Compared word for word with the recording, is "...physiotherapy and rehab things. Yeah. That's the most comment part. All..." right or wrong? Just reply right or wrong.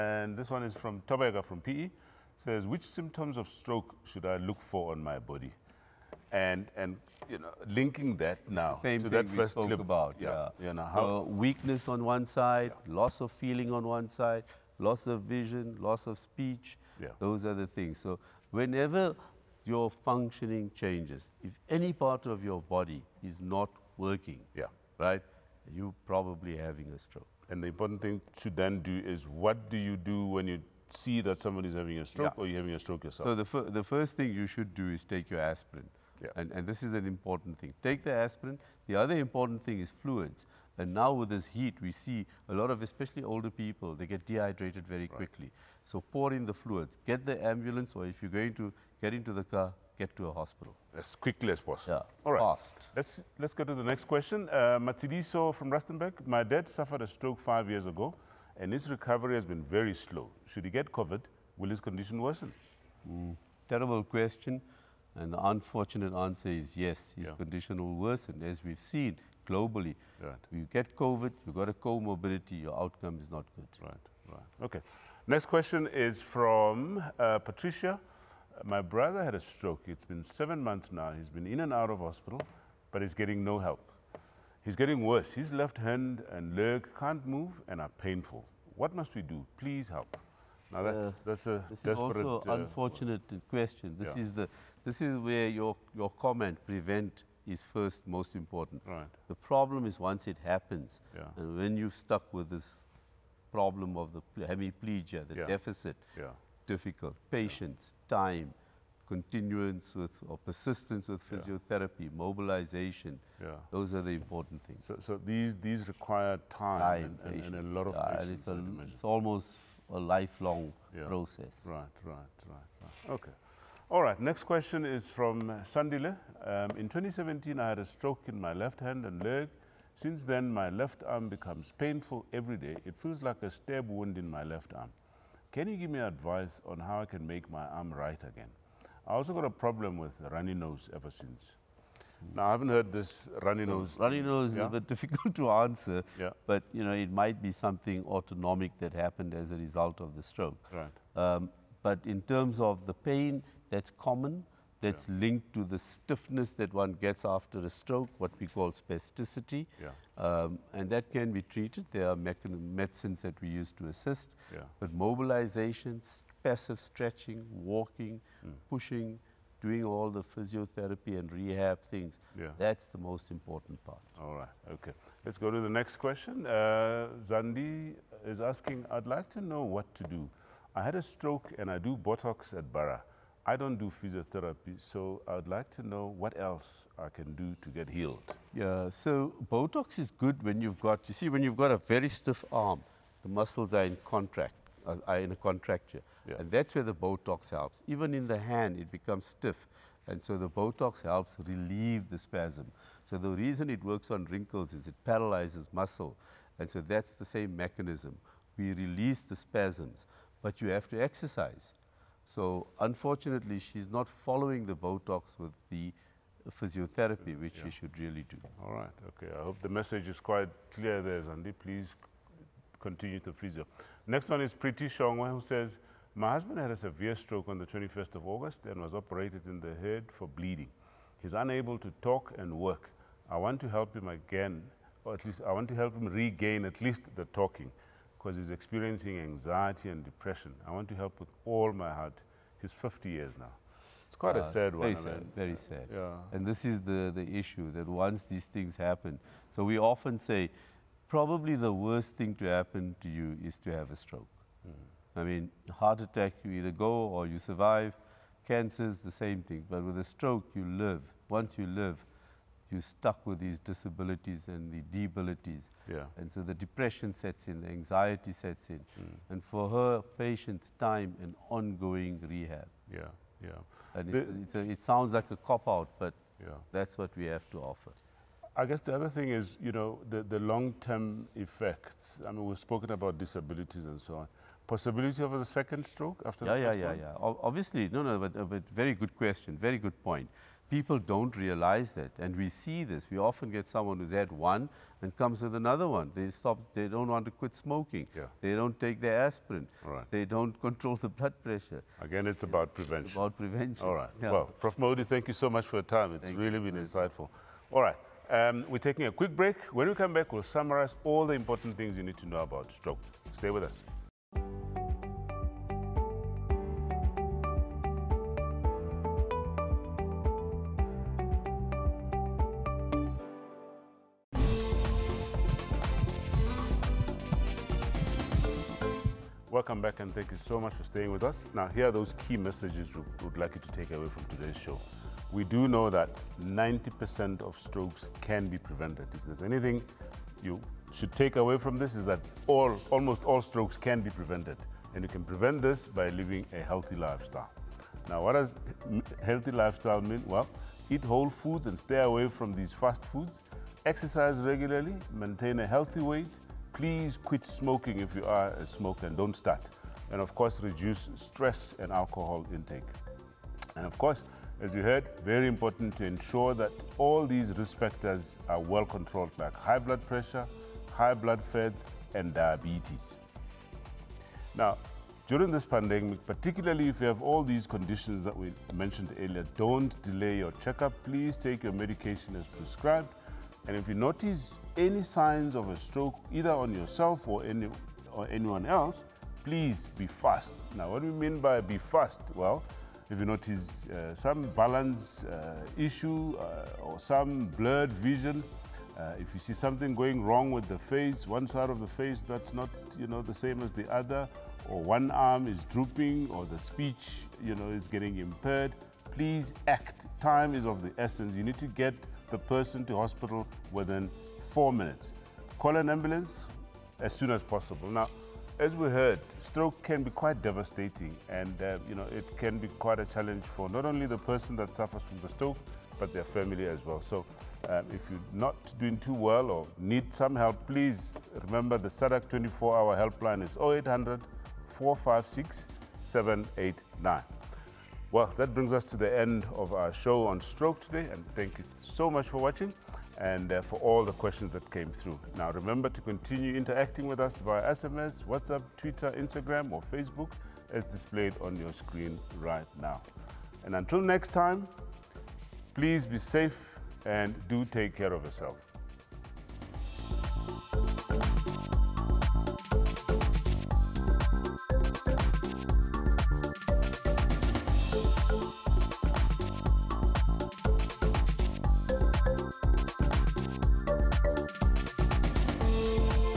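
wrong.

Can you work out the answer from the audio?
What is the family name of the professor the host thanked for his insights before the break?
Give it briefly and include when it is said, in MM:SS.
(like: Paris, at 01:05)
Modi, at 05:04.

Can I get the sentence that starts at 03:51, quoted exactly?
He's unable to talk and work.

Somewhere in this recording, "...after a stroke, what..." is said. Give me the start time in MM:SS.
02:37.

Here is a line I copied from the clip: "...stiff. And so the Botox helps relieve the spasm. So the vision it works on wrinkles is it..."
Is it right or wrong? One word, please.
wrong.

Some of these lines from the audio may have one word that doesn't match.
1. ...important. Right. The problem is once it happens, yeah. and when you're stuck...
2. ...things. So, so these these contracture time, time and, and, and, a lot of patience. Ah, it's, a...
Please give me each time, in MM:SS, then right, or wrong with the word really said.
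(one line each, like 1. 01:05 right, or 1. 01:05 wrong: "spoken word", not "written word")
1. 01:38 right
2. 01:54 wrong: "require", not "contracture".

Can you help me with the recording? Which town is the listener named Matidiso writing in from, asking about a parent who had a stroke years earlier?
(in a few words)
Rustenburg.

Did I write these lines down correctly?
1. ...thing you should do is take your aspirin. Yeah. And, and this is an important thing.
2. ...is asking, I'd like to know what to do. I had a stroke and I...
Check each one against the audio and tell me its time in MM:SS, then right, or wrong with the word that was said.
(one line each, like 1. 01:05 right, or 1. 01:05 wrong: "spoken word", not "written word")
1. 00:34 right
2. 02:58 right.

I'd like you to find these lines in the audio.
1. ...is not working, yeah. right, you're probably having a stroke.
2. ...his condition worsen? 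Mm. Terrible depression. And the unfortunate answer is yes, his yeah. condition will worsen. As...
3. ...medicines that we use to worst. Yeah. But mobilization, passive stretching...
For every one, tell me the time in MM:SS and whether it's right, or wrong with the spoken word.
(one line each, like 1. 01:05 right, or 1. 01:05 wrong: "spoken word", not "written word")
1. 00:23 right
2. 01:01 wrong: "question", not "depression"
3. 02:42 wrong: "assist", not "worst".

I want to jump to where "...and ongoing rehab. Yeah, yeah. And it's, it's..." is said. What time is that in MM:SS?
04:31.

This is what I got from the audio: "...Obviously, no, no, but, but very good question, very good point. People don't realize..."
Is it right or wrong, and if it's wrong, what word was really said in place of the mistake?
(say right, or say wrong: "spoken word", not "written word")
right.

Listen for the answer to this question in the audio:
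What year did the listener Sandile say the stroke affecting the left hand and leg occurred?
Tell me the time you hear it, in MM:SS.
02:06.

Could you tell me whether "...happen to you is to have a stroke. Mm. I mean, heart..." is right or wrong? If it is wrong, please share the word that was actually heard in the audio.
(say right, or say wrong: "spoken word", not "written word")
right.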